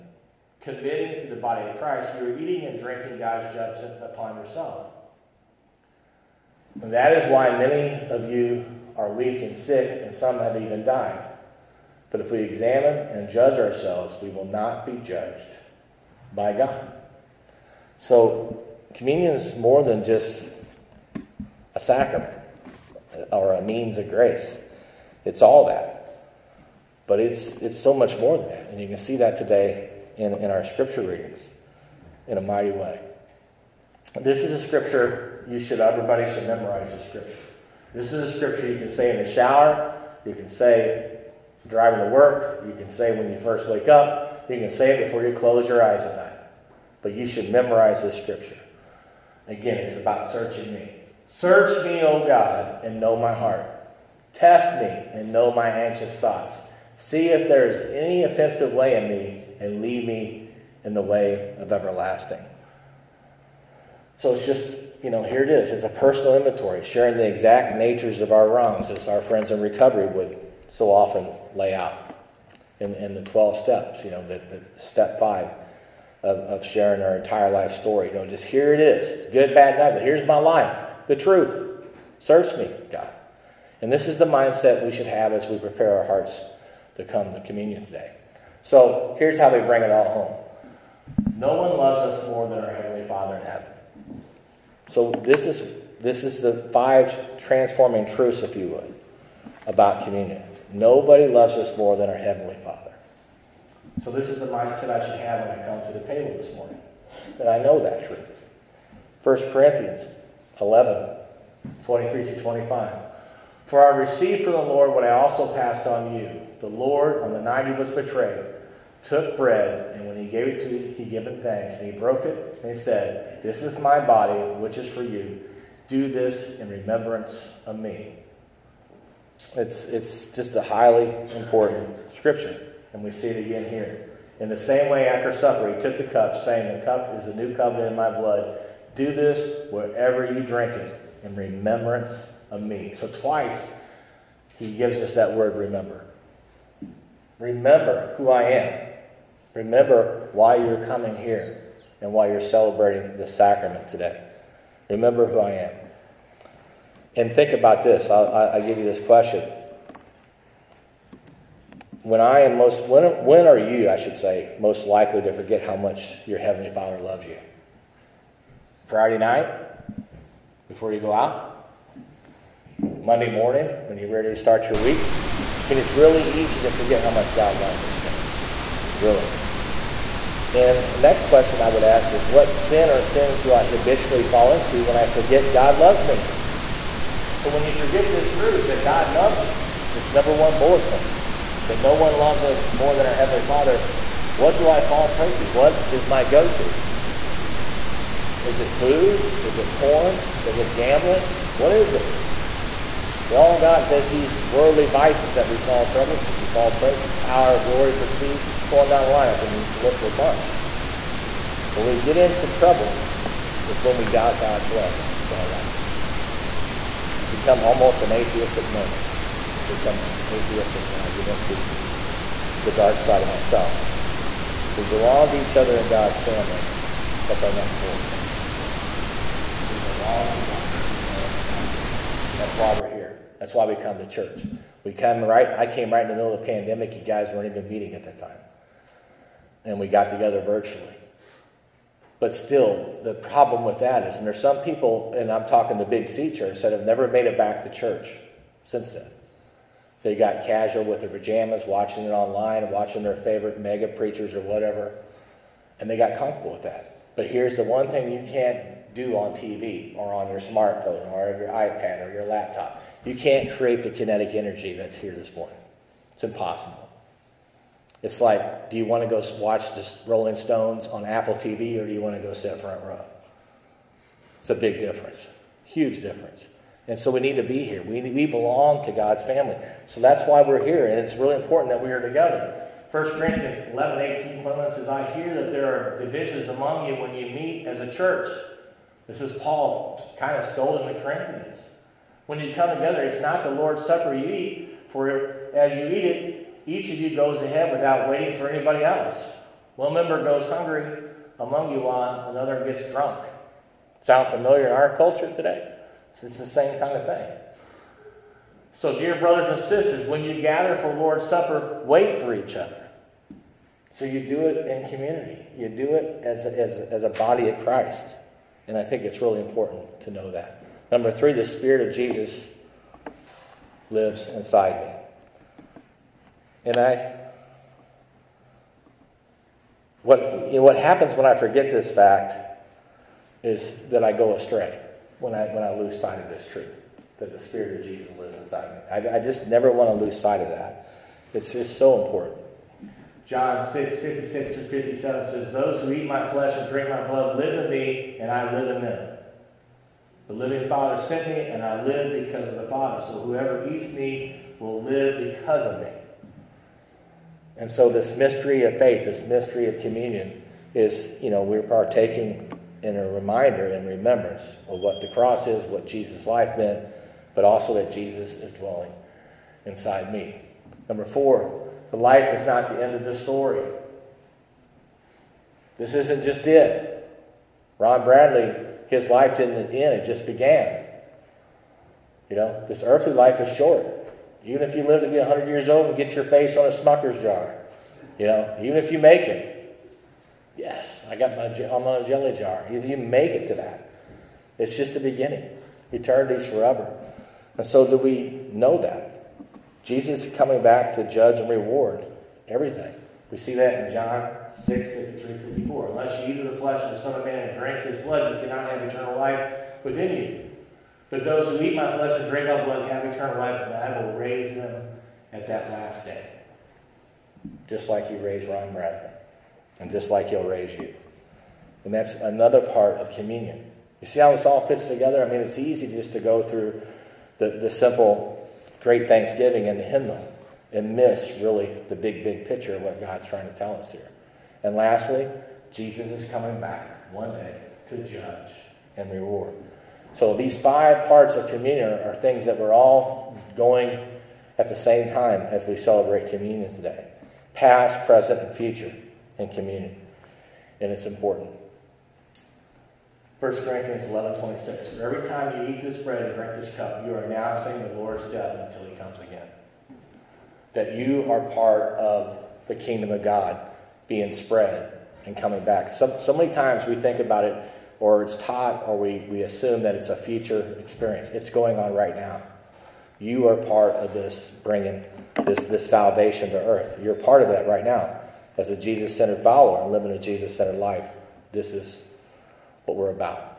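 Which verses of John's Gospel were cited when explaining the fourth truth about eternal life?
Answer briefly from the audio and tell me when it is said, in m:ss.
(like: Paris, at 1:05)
John 6:53-54, at 6:43.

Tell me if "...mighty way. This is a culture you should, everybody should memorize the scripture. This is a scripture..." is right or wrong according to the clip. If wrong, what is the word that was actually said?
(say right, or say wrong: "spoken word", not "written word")
wrong: "scripture", not "culture".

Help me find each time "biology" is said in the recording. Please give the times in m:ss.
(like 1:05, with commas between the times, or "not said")
not said.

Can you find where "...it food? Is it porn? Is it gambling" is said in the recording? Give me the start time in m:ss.
3:18.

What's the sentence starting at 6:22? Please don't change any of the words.
You know, this earthly life is short.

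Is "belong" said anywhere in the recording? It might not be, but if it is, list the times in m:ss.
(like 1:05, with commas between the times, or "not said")
3:44, 3:49, 4:38.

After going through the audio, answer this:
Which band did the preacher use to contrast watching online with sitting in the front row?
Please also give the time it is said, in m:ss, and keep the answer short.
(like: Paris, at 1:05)
The Rolling Stones, at 4:30.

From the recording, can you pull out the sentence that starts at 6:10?
Number four, but life is not the end of the story.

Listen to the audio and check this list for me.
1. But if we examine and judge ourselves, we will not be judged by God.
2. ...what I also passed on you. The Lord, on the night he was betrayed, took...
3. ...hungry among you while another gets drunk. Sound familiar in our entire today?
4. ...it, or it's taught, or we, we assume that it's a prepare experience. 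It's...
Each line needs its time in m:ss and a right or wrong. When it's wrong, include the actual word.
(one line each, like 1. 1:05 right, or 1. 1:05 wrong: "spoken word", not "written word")
1. 0:12 right
2. 1:54 right
3. 5:00 wrong: "culture", not "entire"
4. 7:47 wrong: "future", not "prepare".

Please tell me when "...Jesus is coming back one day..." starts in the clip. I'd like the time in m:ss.
7:15.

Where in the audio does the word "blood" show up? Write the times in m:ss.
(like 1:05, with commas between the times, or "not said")
2:18, 5:47, 6:48, 6:52.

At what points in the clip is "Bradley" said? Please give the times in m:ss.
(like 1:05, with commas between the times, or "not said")
6:18, 6:58.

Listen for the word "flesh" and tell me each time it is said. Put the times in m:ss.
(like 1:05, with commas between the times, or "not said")
5:46, 6:46, 6:51.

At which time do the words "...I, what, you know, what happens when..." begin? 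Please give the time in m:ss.
5:26.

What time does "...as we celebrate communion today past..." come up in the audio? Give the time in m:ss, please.
7:25.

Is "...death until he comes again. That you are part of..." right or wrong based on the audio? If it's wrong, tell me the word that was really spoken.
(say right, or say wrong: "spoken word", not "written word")
right.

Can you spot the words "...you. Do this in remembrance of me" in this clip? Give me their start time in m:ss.
2:05.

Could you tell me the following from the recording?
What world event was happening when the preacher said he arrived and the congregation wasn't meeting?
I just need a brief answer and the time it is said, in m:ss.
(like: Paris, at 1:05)
The pandemic, at 3:56.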